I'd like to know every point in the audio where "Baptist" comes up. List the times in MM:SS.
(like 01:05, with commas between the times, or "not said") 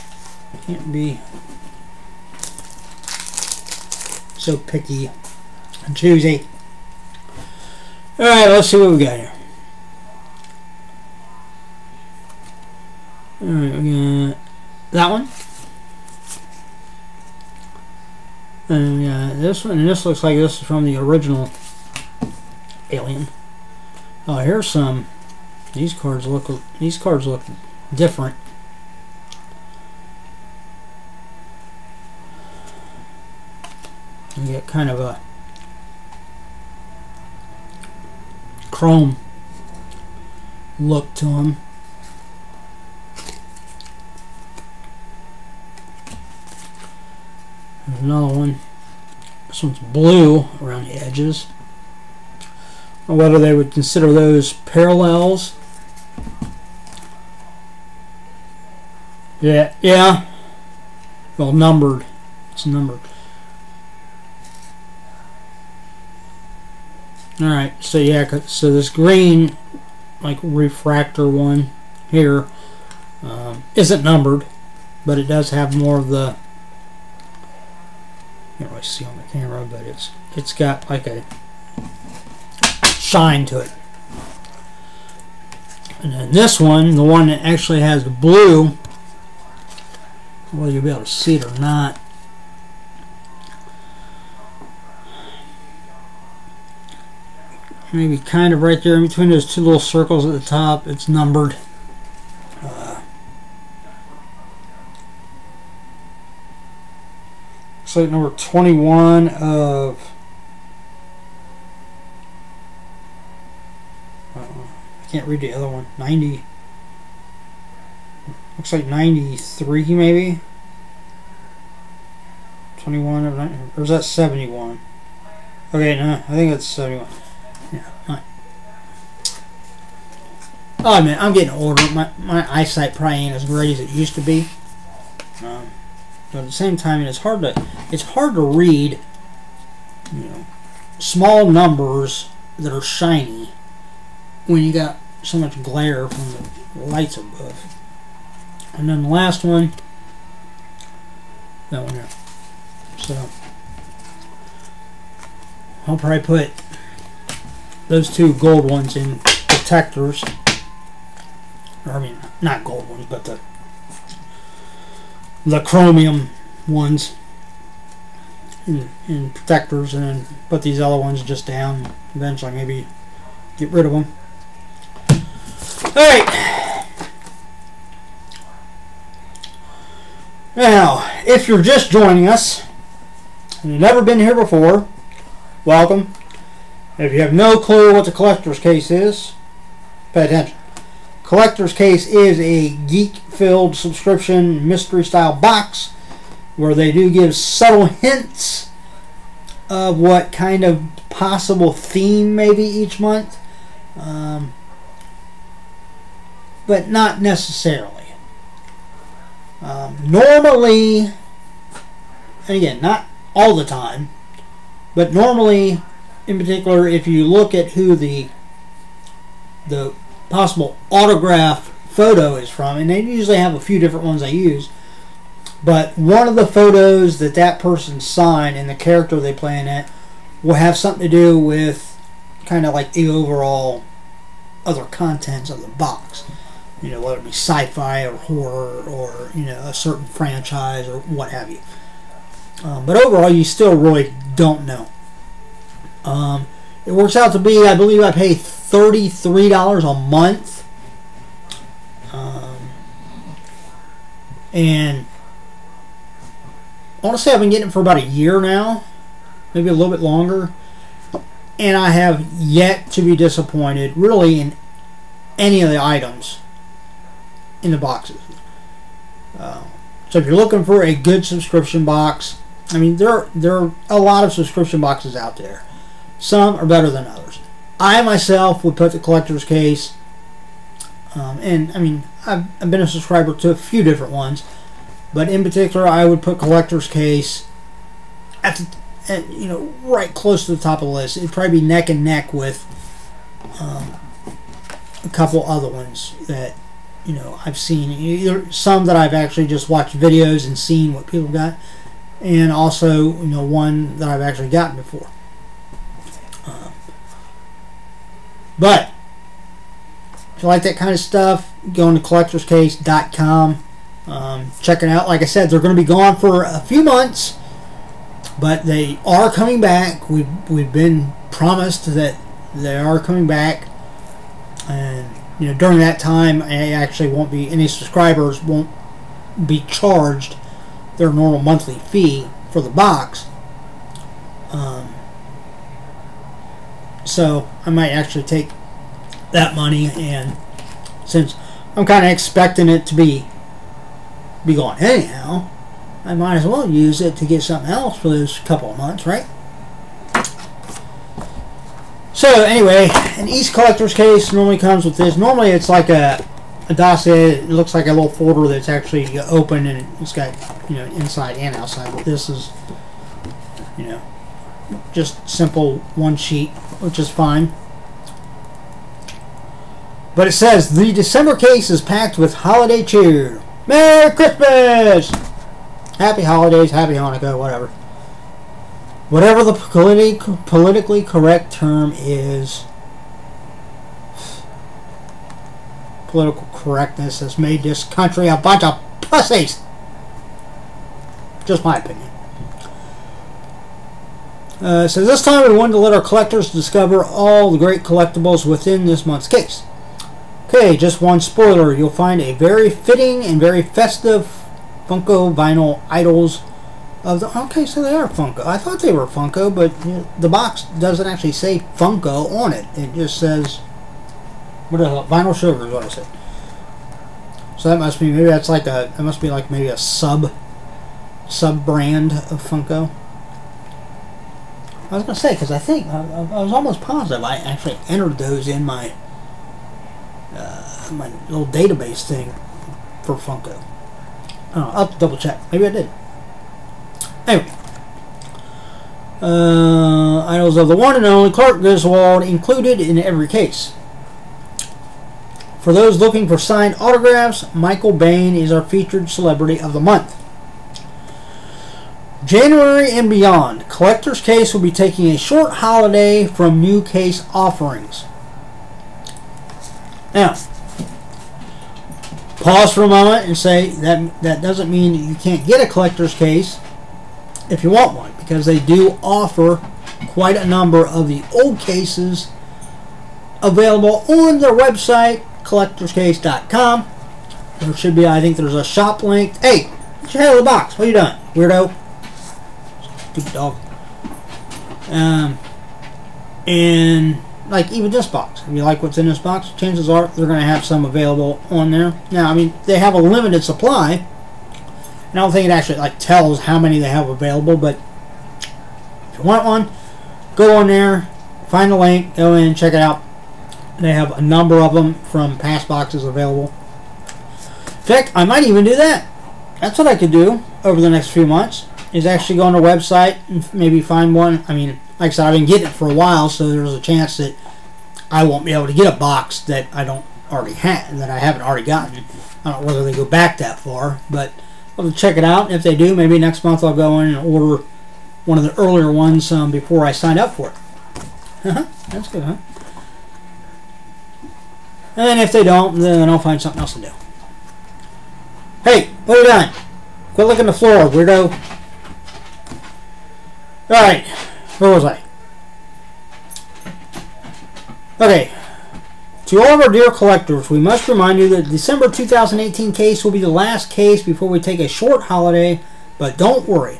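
not said.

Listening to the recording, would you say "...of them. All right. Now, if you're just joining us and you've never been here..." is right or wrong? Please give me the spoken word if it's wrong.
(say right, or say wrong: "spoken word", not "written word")
right.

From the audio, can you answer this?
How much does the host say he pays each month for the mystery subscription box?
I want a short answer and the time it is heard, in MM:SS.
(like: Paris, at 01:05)
$33, at 04:08.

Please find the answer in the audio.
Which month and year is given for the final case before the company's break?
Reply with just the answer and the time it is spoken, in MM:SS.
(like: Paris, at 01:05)
December 2018, at 09:11.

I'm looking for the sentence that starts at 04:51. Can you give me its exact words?
It'd probably be neck and neck with um, a couple other ones that you know I've seen.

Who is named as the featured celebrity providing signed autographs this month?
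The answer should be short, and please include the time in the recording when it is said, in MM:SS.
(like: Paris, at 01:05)
Michael Bain, at 07:27.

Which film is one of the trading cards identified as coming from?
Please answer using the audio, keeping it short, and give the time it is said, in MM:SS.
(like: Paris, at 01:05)
Alien, at 00:20.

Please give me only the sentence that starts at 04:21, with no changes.
And I have yet to be disappointed, really, in any of the items in the boxes.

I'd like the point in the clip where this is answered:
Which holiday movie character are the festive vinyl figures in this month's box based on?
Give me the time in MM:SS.
07:21.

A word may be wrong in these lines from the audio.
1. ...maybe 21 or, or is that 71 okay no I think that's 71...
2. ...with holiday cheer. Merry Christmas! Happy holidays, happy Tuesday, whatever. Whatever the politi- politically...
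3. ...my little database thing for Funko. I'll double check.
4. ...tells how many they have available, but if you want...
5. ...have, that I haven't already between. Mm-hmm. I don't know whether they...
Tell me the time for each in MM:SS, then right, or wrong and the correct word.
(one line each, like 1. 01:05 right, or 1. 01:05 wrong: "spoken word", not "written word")
1. 01:59 right
2. 06:12 wrong: "Hanukkah", not "Tuesday"
3. 07:10 right
4. 08:15 right
5. 08:40 wrong: "gotten", not "between".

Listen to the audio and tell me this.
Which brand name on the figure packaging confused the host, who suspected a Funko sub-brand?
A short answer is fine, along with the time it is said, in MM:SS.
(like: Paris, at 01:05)
Vinyl Sugar, at 06:55.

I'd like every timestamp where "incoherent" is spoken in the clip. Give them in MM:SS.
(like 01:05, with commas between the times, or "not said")
not said.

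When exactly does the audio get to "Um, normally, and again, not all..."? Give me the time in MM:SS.
03:29.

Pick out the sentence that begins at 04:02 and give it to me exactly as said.
Um, but overall, you still really don't know.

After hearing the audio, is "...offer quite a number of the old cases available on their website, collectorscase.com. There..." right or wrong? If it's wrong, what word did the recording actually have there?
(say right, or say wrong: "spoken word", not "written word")
right.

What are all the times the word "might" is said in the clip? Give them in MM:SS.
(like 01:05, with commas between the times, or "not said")
05:37, 05:46, 08:28.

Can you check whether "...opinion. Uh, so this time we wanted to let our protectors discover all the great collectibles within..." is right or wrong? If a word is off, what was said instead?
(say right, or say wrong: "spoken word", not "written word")
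wrong: "collectors", not "protectors".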